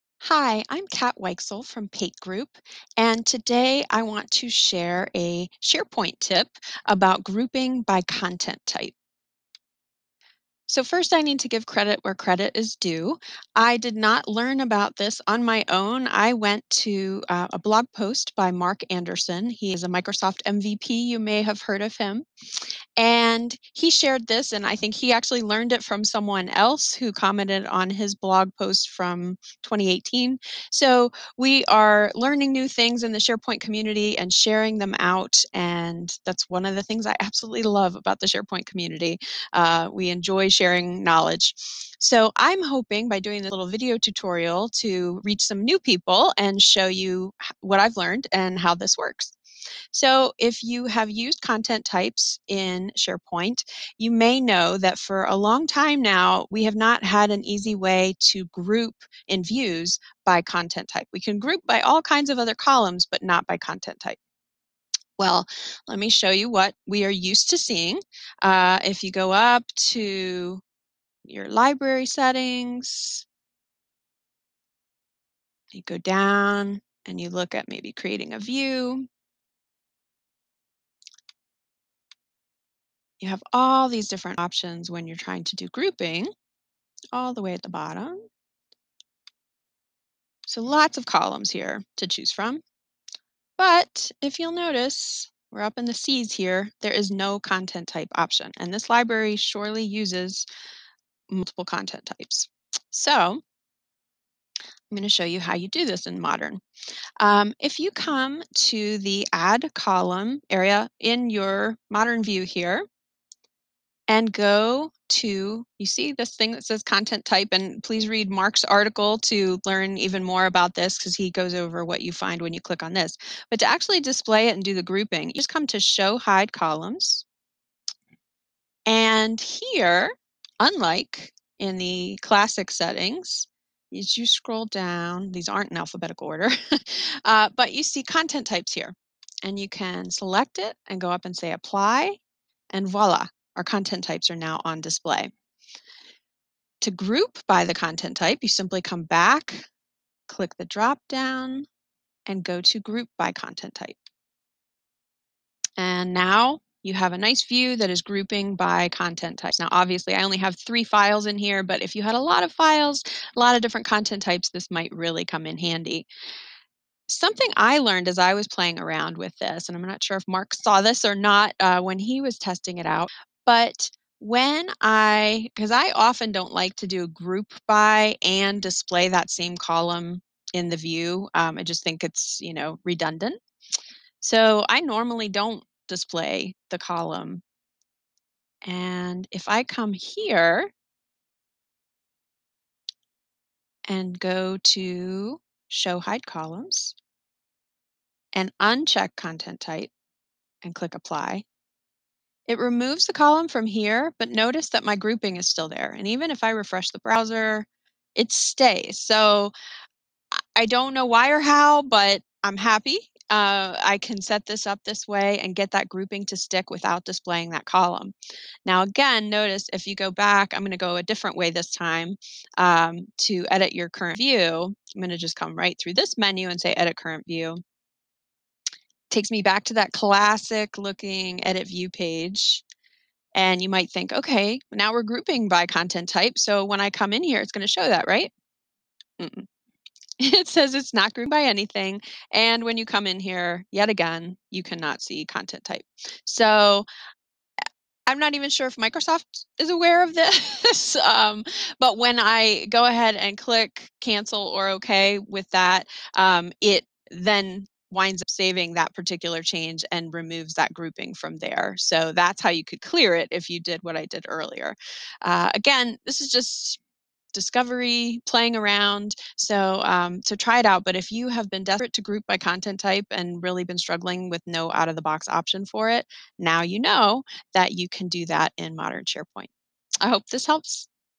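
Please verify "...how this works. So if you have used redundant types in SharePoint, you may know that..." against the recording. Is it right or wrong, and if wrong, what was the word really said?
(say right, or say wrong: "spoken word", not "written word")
wrong: "content", not "redundant".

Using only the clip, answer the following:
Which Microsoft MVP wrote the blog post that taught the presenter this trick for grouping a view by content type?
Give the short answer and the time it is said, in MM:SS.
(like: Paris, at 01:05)
Marc Anderson, at 00:18.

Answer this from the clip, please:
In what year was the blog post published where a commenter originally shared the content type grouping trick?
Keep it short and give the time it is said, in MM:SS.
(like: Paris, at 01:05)
2018, at 00:29.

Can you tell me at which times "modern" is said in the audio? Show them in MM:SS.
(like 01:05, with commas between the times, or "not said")
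01:46, 01:51, 04:38.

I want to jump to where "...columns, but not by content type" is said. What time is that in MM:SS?
01:02.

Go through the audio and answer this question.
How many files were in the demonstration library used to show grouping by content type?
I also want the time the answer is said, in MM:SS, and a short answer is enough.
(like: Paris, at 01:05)
3, at 02:40.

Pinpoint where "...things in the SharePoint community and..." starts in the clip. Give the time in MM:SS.
00:32.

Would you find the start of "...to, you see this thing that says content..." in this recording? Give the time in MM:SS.
01:55.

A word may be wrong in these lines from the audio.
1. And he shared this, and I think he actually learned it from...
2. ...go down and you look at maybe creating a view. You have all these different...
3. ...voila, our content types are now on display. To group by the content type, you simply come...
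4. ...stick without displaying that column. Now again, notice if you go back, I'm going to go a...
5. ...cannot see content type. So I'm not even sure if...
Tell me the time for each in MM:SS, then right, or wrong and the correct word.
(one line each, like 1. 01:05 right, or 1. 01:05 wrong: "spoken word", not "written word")
1. 00:22 right
2. 01:15 right
3. 02:22 right
4. 03:36 right
5. 04:04 right.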